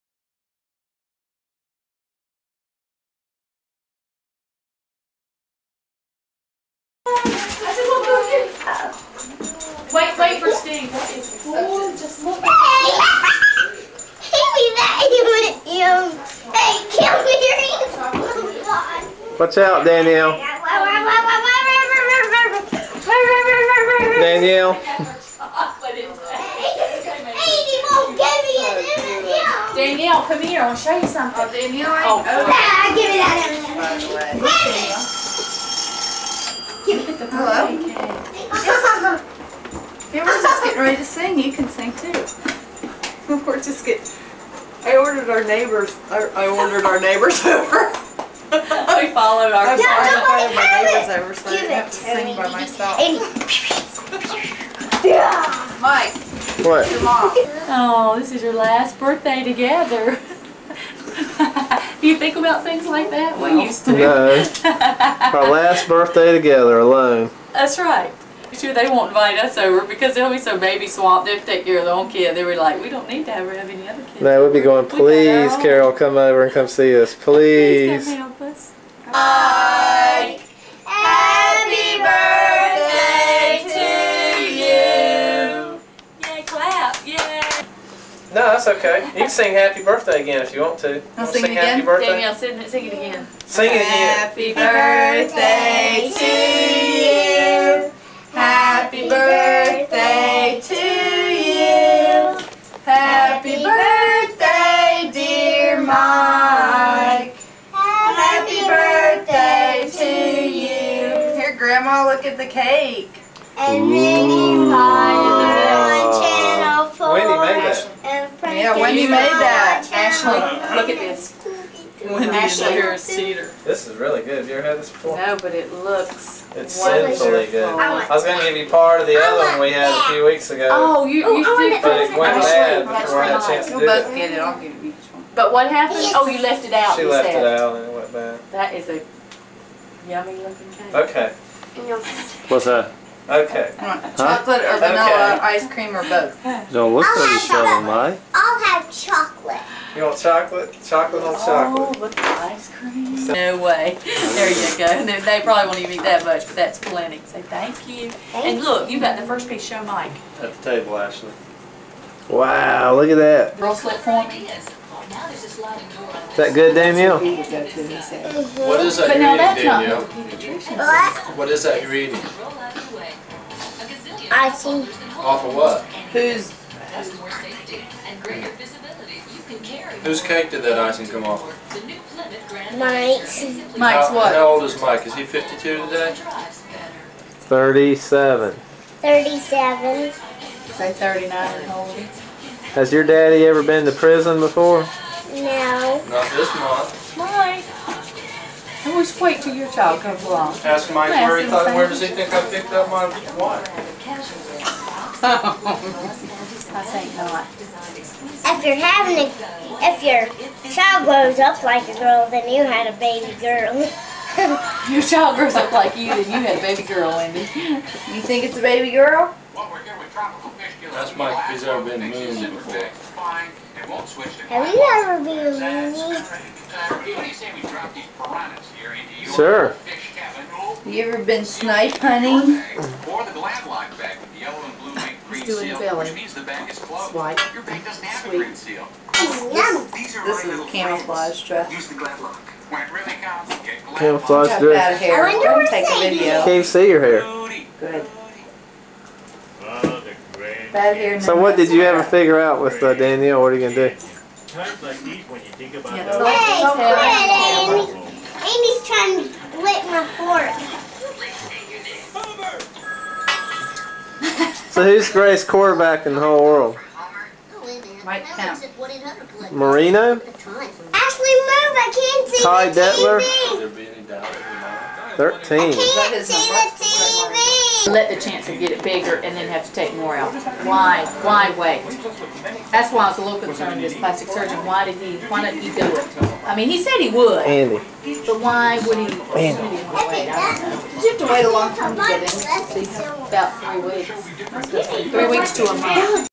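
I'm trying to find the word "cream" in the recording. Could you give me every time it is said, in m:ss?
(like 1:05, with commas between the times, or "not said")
2:25, 2:32, 2:54.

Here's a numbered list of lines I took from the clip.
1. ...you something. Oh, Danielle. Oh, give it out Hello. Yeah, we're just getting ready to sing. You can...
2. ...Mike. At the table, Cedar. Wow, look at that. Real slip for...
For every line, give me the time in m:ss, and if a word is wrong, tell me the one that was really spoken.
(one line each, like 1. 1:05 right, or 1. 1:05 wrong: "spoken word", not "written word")
1. 0:30 right
2. 2:39 wrong: "Ashley", not "Cedar".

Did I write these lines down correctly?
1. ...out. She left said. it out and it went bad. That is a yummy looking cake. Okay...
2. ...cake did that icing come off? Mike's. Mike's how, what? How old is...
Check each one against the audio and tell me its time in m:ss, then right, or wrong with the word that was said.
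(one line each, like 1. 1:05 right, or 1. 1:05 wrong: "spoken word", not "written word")
1. 2:16 right
2. 3:00 right.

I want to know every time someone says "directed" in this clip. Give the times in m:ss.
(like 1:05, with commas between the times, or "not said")
not said.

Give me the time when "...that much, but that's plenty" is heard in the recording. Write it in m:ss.
2:36.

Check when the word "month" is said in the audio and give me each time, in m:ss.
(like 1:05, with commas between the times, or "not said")
3:16, 4:55.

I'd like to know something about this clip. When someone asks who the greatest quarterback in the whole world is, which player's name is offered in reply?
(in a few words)
Marino.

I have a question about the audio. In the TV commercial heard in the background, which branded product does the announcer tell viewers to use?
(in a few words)
Glad Lock.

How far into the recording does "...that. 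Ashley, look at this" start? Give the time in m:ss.
1:59.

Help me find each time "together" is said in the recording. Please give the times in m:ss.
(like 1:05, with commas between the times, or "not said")
0:59, 1:06.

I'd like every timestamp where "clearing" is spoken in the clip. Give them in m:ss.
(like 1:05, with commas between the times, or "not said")
not said.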